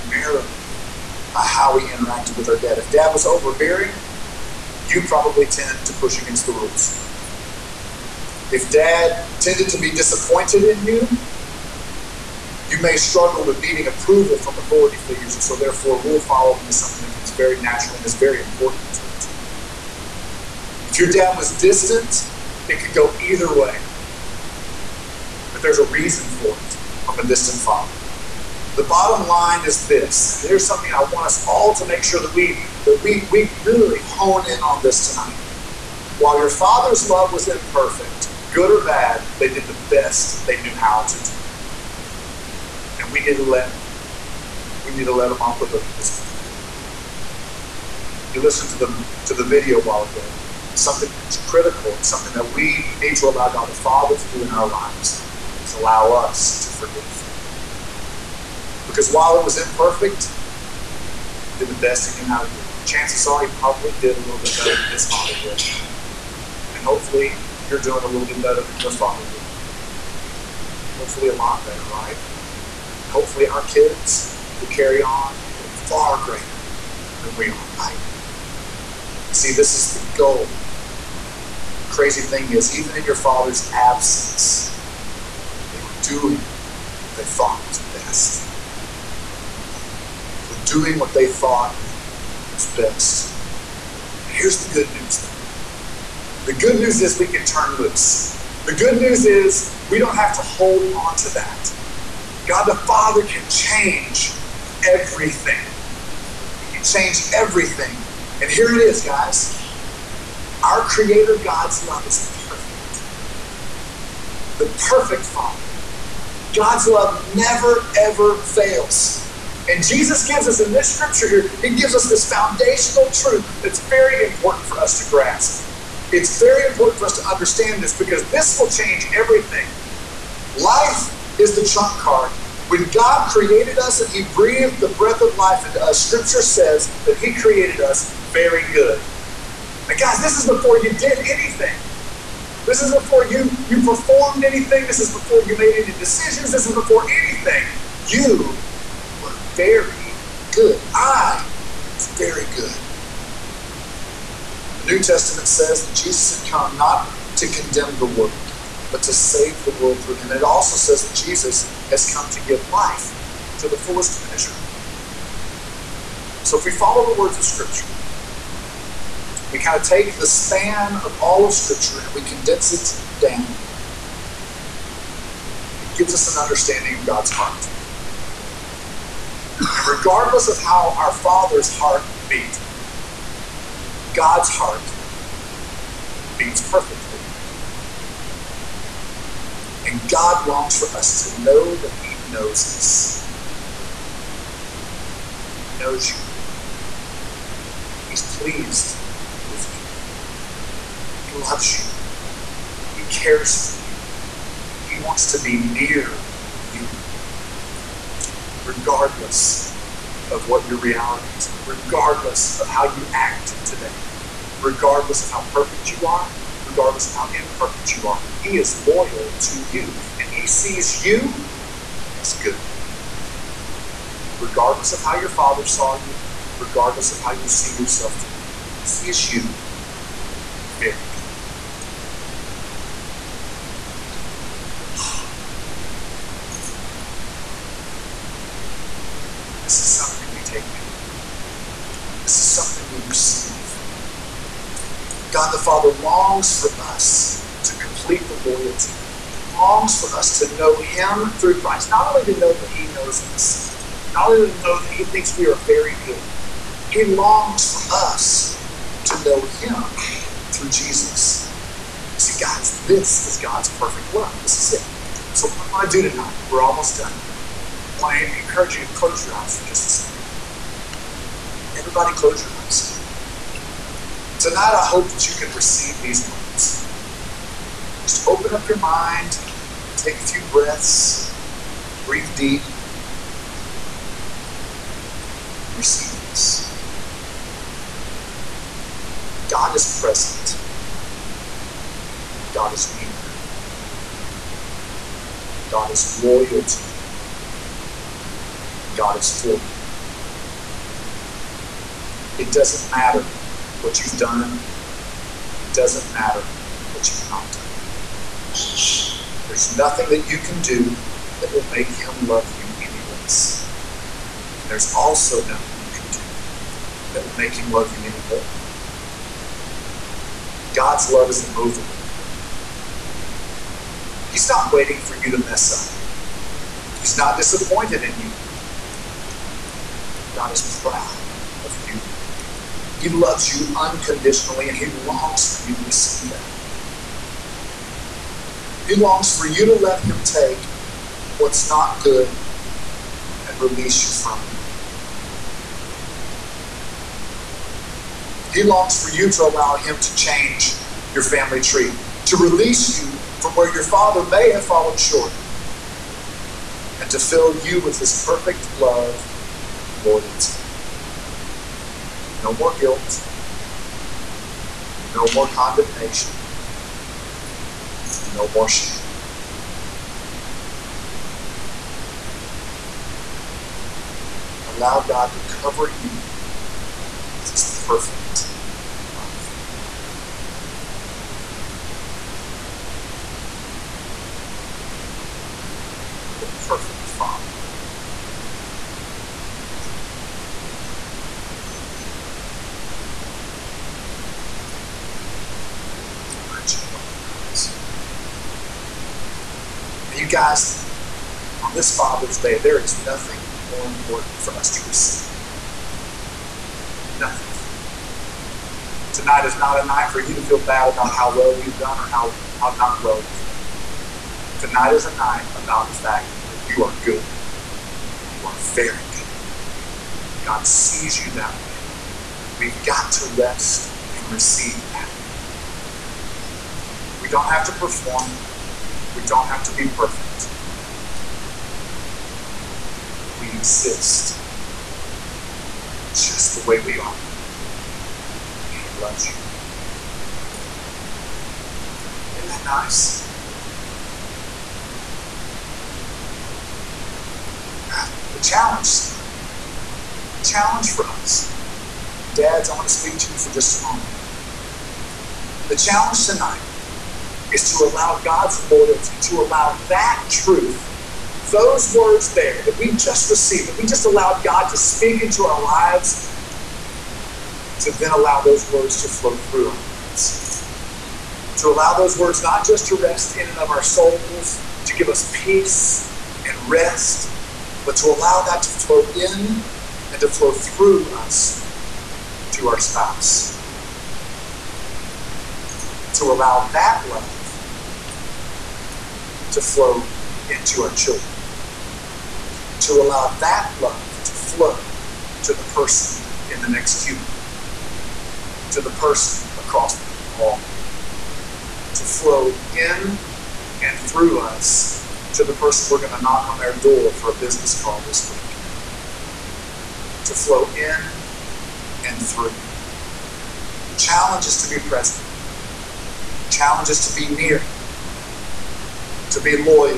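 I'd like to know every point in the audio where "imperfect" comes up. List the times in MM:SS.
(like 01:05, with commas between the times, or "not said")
00:37, 00:59, 03:37.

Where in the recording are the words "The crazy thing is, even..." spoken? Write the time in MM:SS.
01:20.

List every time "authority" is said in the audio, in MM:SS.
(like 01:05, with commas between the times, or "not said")
00:14.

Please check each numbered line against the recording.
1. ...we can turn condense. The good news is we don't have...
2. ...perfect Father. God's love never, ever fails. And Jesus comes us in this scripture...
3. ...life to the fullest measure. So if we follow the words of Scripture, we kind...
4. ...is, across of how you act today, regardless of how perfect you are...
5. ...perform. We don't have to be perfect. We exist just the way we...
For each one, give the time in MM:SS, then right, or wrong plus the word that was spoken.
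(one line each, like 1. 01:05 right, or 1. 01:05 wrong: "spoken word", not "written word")
1. 01:37 wrong: "loose", not "condense"
2. 01:54 wrong: "gives", not "comes"
3. 02:42 right
4. 03:31 wrong: "regardless", not "across"
5. 07:07 right.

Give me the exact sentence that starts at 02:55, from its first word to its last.
It gives us an understanding of God's heart.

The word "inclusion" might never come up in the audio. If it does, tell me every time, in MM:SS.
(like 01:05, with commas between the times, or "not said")
not said.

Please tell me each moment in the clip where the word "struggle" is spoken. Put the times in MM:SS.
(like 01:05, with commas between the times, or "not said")
00:12.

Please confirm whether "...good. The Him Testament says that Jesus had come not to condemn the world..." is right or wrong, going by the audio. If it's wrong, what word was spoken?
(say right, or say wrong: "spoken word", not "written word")
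wrong: "New", not "Him".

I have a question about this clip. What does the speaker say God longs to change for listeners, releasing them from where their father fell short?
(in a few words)
family tree.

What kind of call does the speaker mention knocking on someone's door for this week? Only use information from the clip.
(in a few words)
business call.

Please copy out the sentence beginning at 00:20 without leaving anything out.
If your dad was distant, it could go either way.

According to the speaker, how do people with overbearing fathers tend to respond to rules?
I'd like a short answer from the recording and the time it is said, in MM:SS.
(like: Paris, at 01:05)
push against the rules, at 00:05.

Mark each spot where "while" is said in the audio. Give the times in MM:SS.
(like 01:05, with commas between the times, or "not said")
00:36, 00:49, 00:59.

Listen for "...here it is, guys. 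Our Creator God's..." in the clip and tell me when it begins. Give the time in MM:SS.
01:48.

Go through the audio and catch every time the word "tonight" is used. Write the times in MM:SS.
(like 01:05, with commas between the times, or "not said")
00:35, 04:26, 04:34, 06:49, 06:54, 07:29, 07:36.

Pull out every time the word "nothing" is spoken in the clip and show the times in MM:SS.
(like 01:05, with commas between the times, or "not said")
05:09, 05:15, 06:43, 06:47.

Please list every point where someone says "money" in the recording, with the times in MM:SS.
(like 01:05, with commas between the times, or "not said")
not said.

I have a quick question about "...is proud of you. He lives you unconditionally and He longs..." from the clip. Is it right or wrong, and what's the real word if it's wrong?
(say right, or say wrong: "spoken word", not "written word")
wrong: "loves", not "lives".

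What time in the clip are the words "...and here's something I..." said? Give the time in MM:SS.
00:30.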